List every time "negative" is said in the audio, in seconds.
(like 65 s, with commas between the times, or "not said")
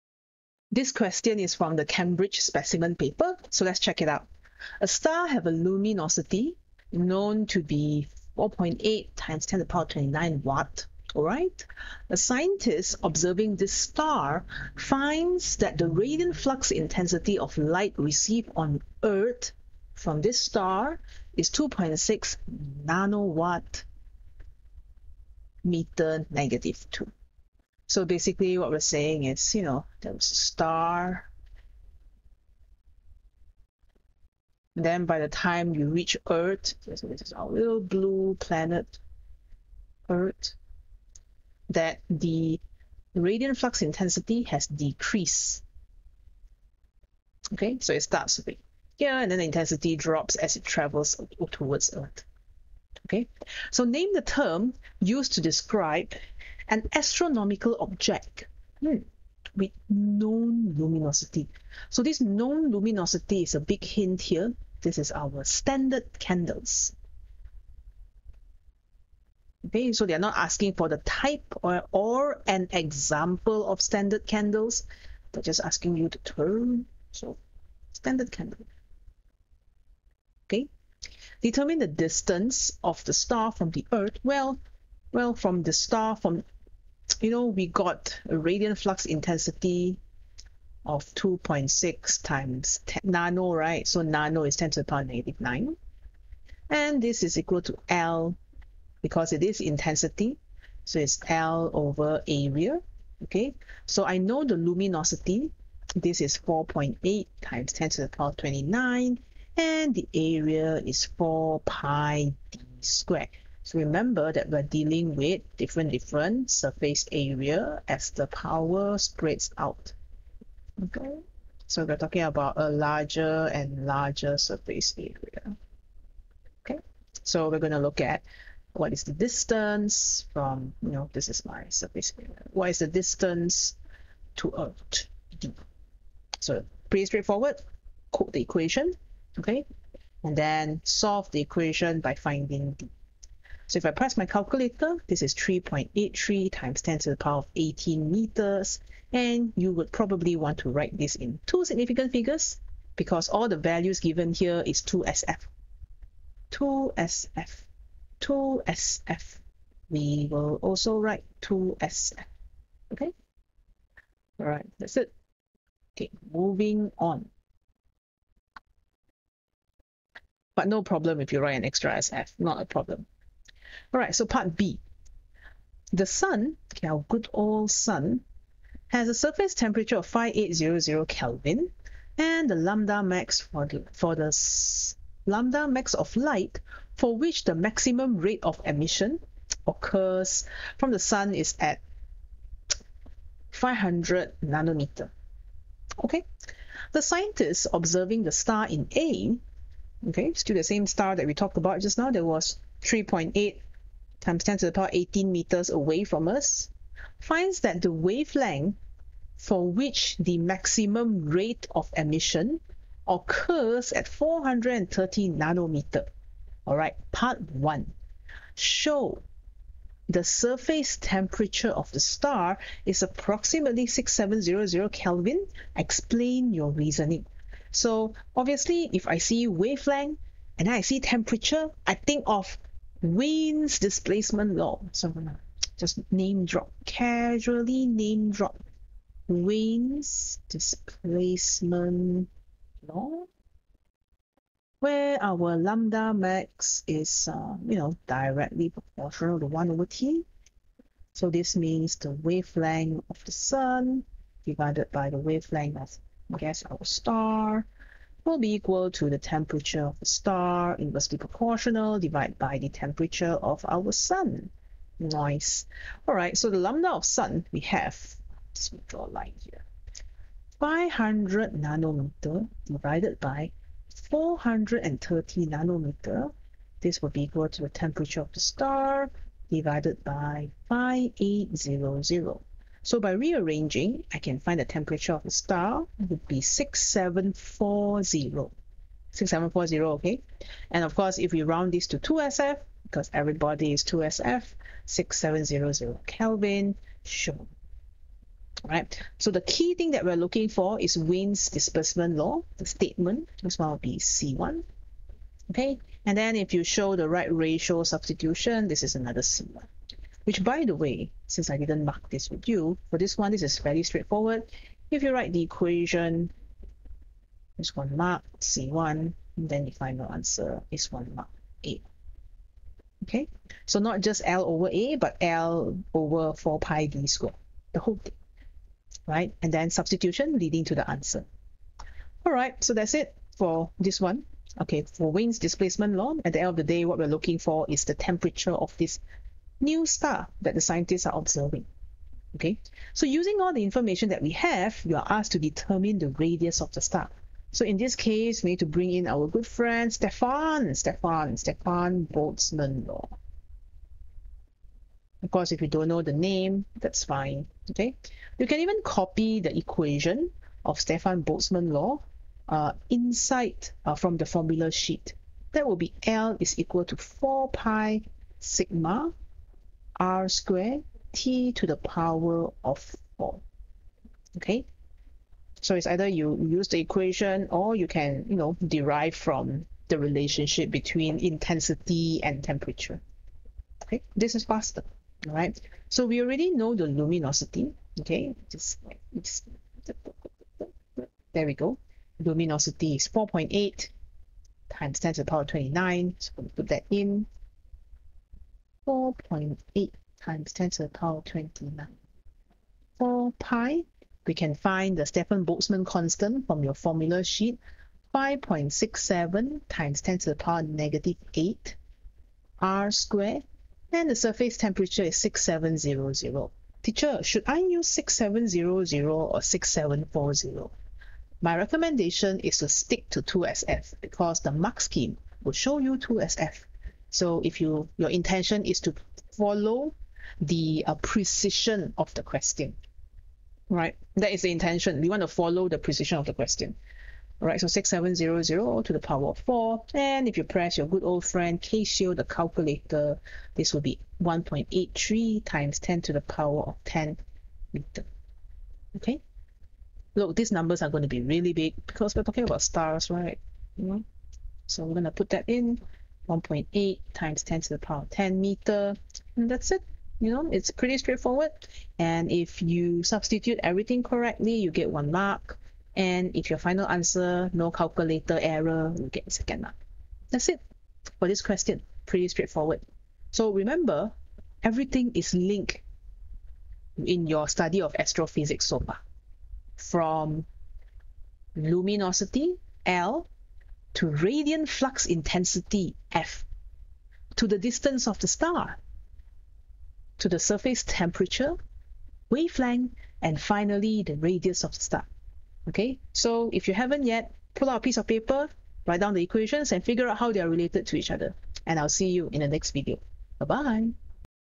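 26 s, 95 s, 410 s.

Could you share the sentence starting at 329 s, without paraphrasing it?
And then substitution leading to the answer.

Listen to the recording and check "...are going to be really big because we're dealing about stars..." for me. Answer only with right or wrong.
wrong.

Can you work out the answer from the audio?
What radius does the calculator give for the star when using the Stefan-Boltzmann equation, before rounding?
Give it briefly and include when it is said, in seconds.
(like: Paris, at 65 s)
1.83 × 10^10 m, at 444 s.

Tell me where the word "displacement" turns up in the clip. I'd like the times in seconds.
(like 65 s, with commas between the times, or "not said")
233 s, 240 s, 301 s, 335 s.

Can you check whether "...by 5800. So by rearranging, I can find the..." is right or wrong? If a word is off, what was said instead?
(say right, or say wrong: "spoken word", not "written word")
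right.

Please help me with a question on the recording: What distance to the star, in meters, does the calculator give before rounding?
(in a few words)
3.83 × 10^18 m.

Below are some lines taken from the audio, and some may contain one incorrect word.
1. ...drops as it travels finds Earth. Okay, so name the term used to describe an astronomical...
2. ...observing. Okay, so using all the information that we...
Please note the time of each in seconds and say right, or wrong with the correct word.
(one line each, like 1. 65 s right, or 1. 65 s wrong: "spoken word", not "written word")
1. 49 s wrong: "towards", not "finds"
2. 341 s right.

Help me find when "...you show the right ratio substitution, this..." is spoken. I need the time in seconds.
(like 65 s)
306 s.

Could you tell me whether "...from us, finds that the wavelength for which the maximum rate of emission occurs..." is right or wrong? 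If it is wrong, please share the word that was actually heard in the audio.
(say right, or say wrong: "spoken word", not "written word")
right.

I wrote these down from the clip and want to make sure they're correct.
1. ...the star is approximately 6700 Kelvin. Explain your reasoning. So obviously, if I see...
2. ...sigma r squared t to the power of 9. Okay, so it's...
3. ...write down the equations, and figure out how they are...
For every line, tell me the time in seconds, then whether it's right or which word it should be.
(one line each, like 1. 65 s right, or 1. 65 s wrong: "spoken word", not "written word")
1. 221 s right
2. 368 s wrong: "4", not "9"
3. 498 s right.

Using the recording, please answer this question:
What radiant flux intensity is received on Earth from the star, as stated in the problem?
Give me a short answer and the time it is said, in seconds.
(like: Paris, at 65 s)
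2.6 nW m^-2, at 21 s.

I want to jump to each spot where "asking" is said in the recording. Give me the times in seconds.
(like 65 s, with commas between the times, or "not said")
70 s, 75 s.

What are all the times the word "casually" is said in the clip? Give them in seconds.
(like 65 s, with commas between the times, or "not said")
236 s.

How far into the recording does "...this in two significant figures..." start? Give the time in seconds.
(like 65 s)
150 s.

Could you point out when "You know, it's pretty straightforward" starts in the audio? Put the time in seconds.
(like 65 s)
460 s.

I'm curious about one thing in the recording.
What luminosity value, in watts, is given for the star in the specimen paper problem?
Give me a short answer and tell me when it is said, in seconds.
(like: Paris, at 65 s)
4.8 × 10^29 W, at 8 s.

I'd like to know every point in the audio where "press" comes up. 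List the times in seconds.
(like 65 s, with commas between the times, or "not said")
143 s, 440 s.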